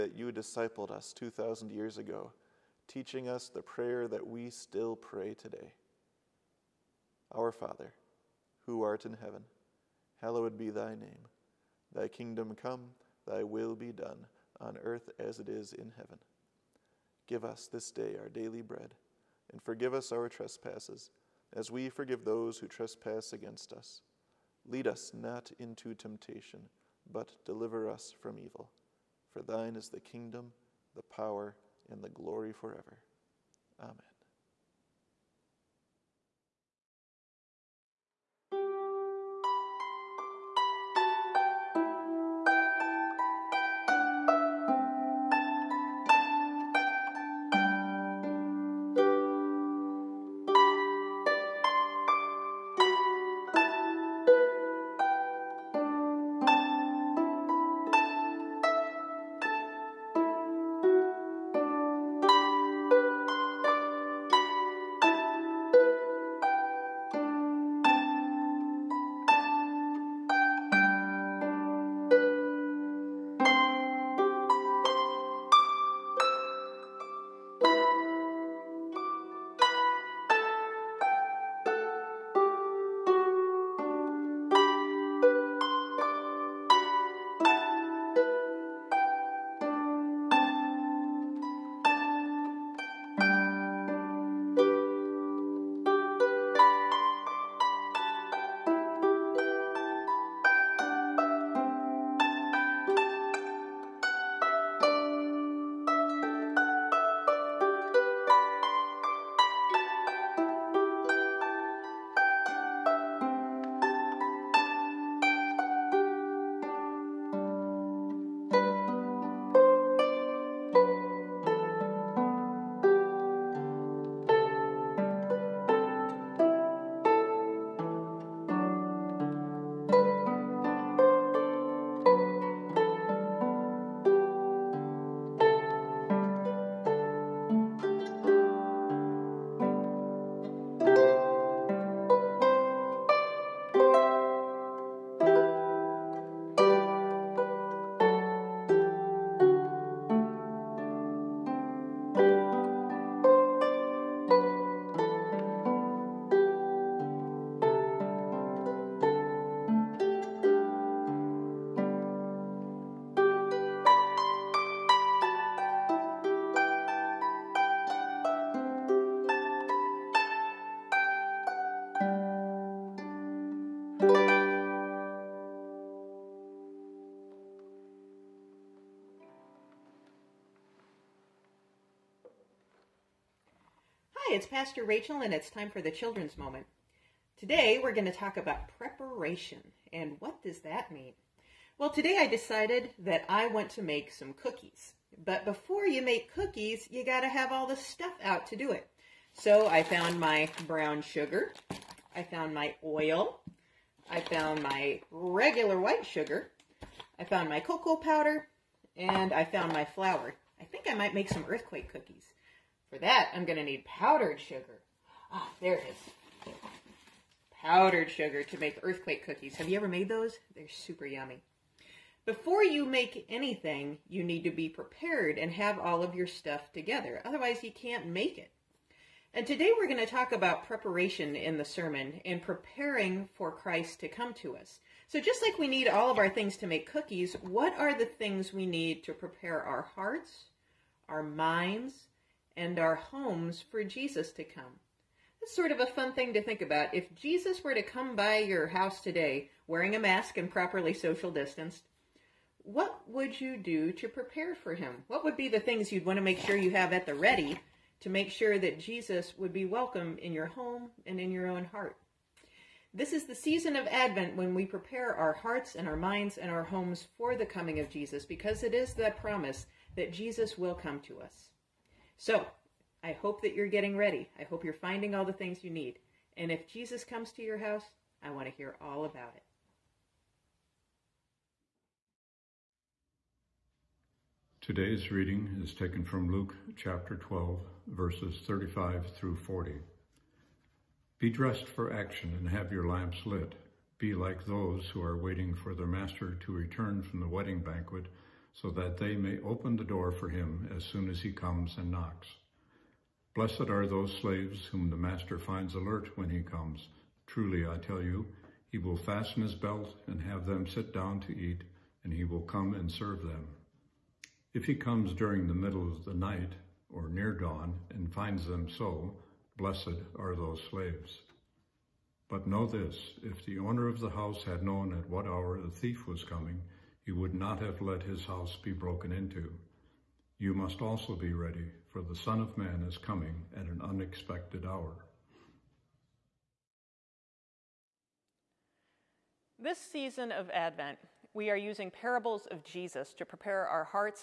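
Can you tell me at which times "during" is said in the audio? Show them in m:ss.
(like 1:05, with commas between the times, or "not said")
5:15.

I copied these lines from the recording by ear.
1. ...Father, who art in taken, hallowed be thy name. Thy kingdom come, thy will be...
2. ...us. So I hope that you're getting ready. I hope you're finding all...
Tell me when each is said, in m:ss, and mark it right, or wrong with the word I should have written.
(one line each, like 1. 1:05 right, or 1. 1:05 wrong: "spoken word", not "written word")
1. 0:07 wrong: "heaven", not "taken"
2. 4:31 right.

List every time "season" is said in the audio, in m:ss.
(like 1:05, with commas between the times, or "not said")
4:23, 5:39.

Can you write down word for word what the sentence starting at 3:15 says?
But before you make cookies, you got to have all the stuff out to do it.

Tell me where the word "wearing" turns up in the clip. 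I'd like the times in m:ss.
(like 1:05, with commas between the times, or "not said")
4:09.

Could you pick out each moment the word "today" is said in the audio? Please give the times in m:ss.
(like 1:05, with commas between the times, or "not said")
0:05, 3:07, 3:11, 3:49, 4:09, 4:44.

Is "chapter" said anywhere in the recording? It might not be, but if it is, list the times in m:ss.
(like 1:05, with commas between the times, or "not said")
4:46.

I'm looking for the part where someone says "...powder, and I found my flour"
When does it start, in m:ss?
3:27.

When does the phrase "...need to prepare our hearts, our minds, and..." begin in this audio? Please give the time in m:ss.
3:58.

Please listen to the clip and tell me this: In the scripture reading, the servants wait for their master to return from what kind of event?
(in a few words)
Wedding banquet.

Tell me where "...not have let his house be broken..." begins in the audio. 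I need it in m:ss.
5:27.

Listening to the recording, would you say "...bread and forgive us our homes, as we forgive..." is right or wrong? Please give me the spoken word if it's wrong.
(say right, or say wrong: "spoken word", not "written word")
wrong: "trespasses", not "homes".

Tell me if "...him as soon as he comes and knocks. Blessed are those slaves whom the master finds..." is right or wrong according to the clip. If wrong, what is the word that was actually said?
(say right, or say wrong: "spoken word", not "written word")
right.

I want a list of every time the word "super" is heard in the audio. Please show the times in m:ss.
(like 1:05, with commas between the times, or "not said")
3:40.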